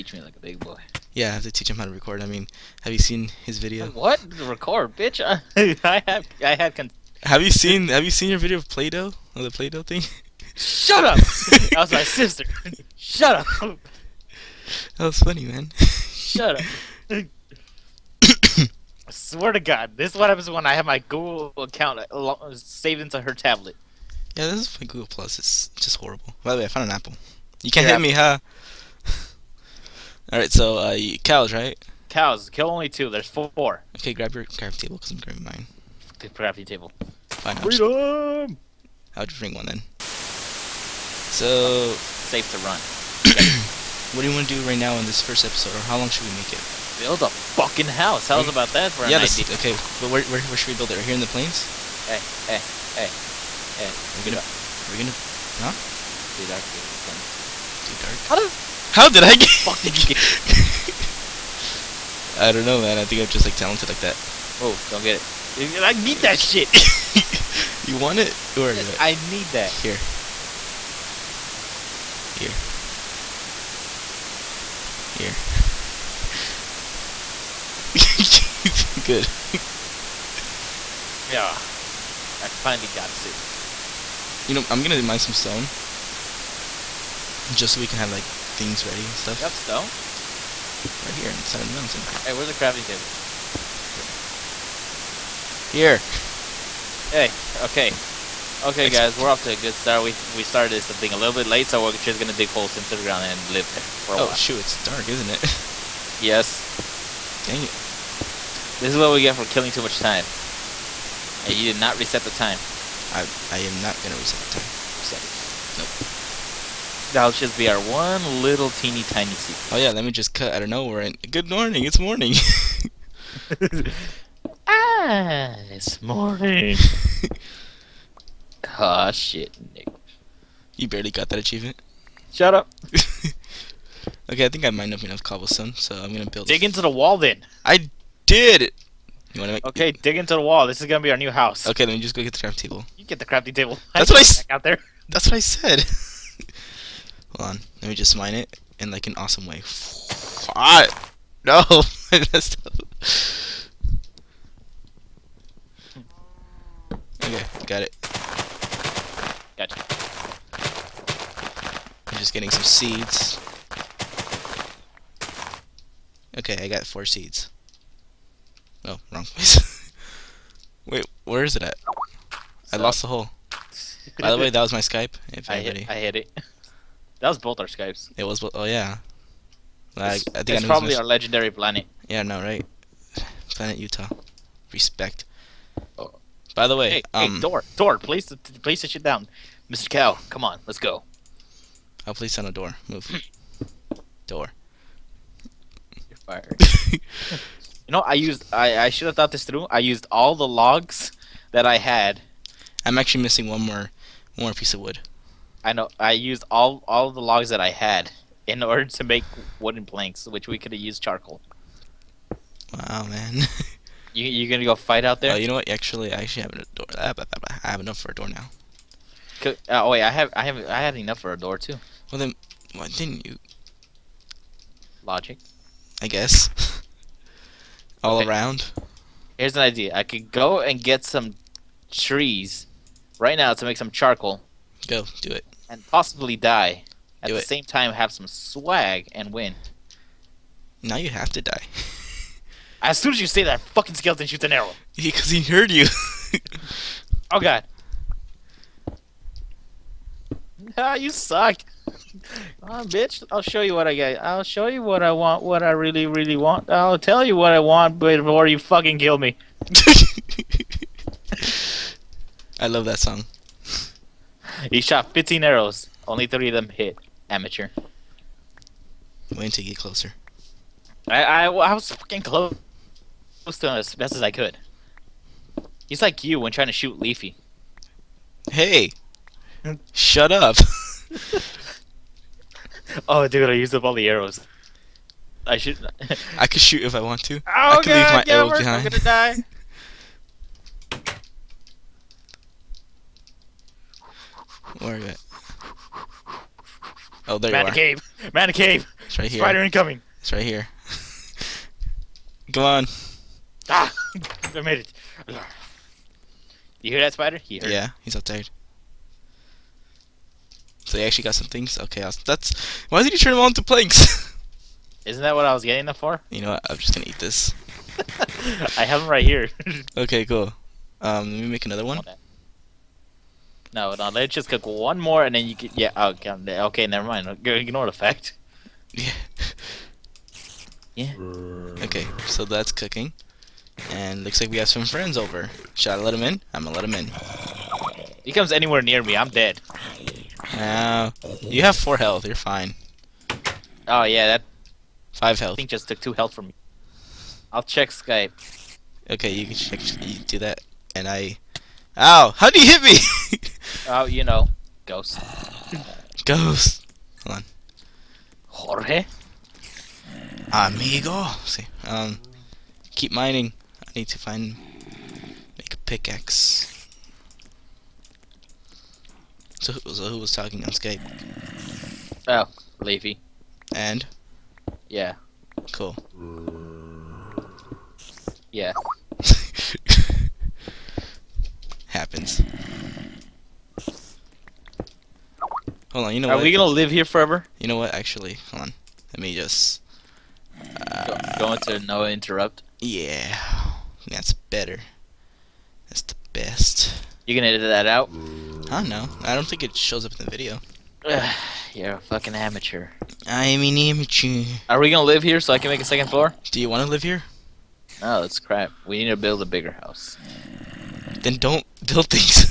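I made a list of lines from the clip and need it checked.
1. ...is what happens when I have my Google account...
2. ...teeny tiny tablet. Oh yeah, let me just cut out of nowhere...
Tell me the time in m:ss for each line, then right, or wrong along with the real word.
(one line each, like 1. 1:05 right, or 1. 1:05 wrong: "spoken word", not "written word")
1. 0:20 right
2. 1:58 wrong: "secret", not "tablet".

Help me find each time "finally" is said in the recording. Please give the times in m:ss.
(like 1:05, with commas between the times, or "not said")
1:22.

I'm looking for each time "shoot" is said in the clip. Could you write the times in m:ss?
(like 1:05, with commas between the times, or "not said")
1:44, 4:04, 4:36, 4:46.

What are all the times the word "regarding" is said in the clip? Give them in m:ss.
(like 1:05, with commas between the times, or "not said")
not said.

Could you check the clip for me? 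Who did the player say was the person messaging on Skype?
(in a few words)
Levy.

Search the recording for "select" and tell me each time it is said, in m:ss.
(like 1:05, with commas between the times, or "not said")
not said.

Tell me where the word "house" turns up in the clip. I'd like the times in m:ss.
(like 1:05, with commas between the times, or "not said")
0:47, 2:21, 6:49.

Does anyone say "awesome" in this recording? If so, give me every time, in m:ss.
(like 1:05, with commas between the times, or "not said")
2:29.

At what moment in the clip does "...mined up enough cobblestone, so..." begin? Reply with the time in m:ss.
2:14.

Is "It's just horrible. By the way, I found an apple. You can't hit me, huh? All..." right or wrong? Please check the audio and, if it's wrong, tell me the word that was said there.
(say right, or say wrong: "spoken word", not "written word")
right.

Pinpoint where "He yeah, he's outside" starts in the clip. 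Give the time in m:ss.
5:07.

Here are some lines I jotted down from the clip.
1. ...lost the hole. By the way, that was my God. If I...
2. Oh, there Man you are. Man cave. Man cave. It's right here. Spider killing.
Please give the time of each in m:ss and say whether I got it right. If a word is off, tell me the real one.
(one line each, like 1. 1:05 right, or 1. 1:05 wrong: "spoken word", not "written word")
1. 2:52 wrong: "Skype", not "God"
2. 4:57 wrong: "incoming", not "killing".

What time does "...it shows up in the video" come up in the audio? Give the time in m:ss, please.
6:39.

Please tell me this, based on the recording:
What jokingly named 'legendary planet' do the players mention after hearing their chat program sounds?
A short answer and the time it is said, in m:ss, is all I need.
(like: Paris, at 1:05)
Planet Utah, at 3:03.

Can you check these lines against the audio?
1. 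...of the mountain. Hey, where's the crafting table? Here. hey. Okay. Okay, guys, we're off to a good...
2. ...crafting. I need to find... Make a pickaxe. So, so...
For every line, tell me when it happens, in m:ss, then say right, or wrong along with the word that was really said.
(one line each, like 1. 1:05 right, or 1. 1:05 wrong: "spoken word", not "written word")
1. 1:31 right
2. 6:03 wrong: "mining", not "crafting".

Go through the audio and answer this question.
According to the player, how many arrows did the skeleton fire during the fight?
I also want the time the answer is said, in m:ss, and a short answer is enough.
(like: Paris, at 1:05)
15, at 4:25.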